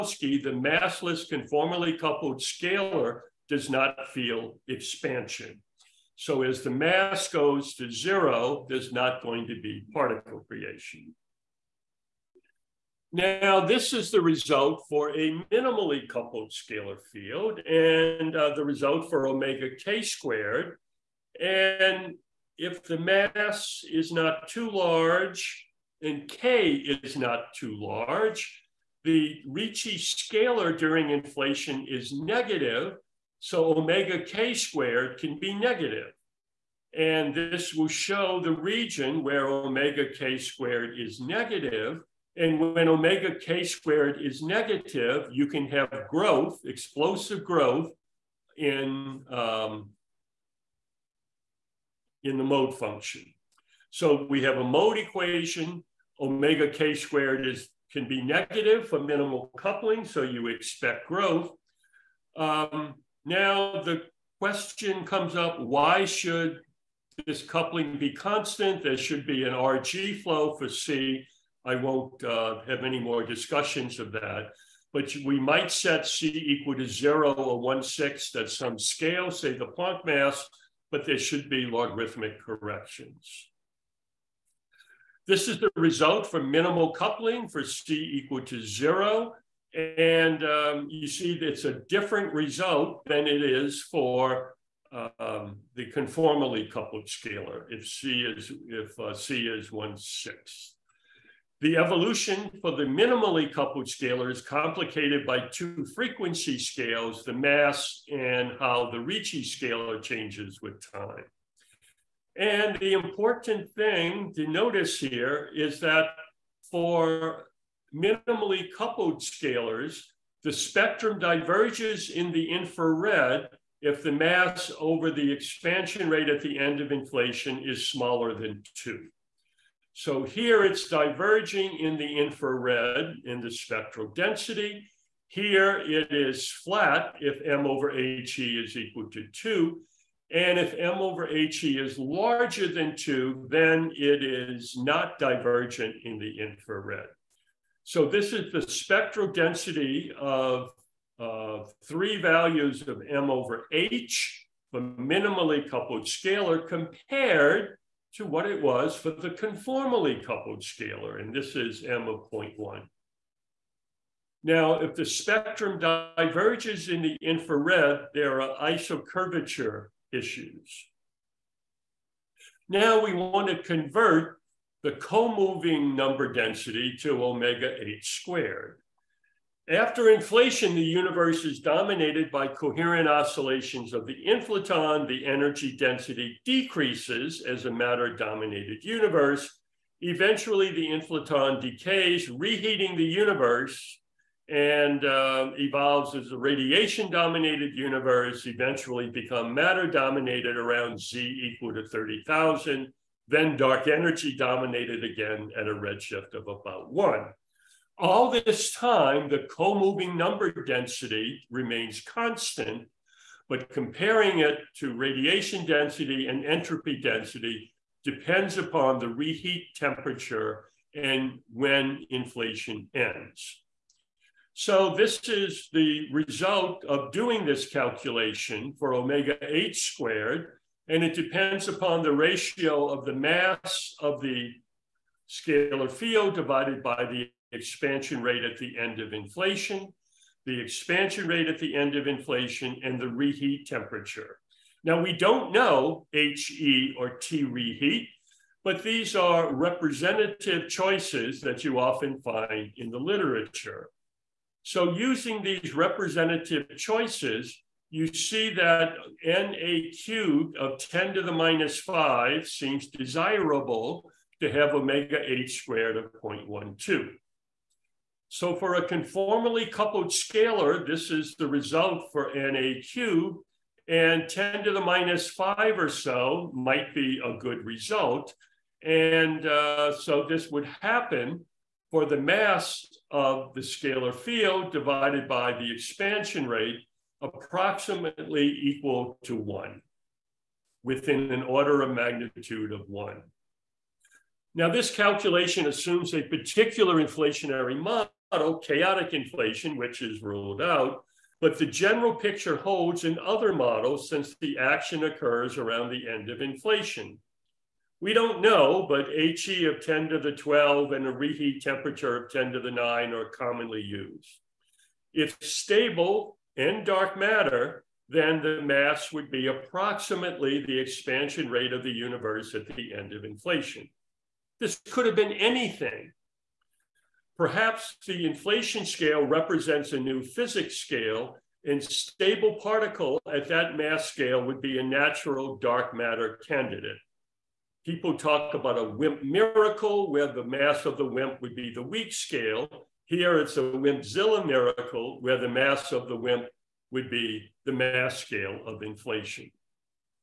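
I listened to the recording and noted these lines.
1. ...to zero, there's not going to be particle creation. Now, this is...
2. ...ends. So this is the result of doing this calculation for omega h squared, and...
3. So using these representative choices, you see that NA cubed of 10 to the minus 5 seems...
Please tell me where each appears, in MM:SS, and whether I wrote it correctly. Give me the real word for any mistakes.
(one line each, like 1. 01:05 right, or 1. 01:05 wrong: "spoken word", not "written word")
1. 00:07 right
2. 03:42 right
3. 04:14 right.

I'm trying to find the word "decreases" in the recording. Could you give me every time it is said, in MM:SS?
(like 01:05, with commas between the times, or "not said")
03:06.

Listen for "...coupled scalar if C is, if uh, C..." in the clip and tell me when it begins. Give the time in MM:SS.
01:36.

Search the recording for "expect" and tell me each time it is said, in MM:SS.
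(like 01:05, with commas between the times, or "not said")
01:00.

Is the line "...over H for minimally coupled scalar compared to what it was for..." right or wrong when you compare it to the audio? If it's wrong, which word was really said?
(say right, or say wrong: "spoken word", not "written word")
right.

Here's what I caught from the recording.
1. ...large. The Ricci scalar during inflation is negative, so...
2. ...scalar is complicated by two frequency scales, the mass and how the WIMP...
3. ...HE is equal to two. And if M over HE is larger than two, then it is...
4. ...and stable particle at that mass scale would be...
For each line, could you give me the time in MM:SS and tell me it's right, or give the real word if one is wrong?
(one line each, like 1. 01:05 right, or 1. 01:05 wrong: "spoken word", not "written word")
1. 00:27 right
2. 01:43 wrong: "Ricci", not "WIMP"
3. 02:17 right
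4. 05:31 right.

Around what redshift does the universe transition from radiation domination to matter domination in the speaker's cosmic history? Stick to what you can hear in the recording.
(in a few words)
30,000.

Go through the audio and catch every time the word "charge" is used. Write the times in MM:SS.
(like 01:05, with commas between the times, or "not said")
not said.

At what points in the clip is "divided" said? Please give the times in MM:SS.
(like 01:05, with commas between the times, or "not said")
03:56, 04:44.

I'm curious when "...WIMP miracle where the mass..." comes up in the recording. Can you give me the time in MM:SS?
05:38.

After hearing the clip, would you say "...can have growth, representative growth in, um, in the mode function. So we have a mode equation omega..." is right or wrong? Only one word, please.
wrong.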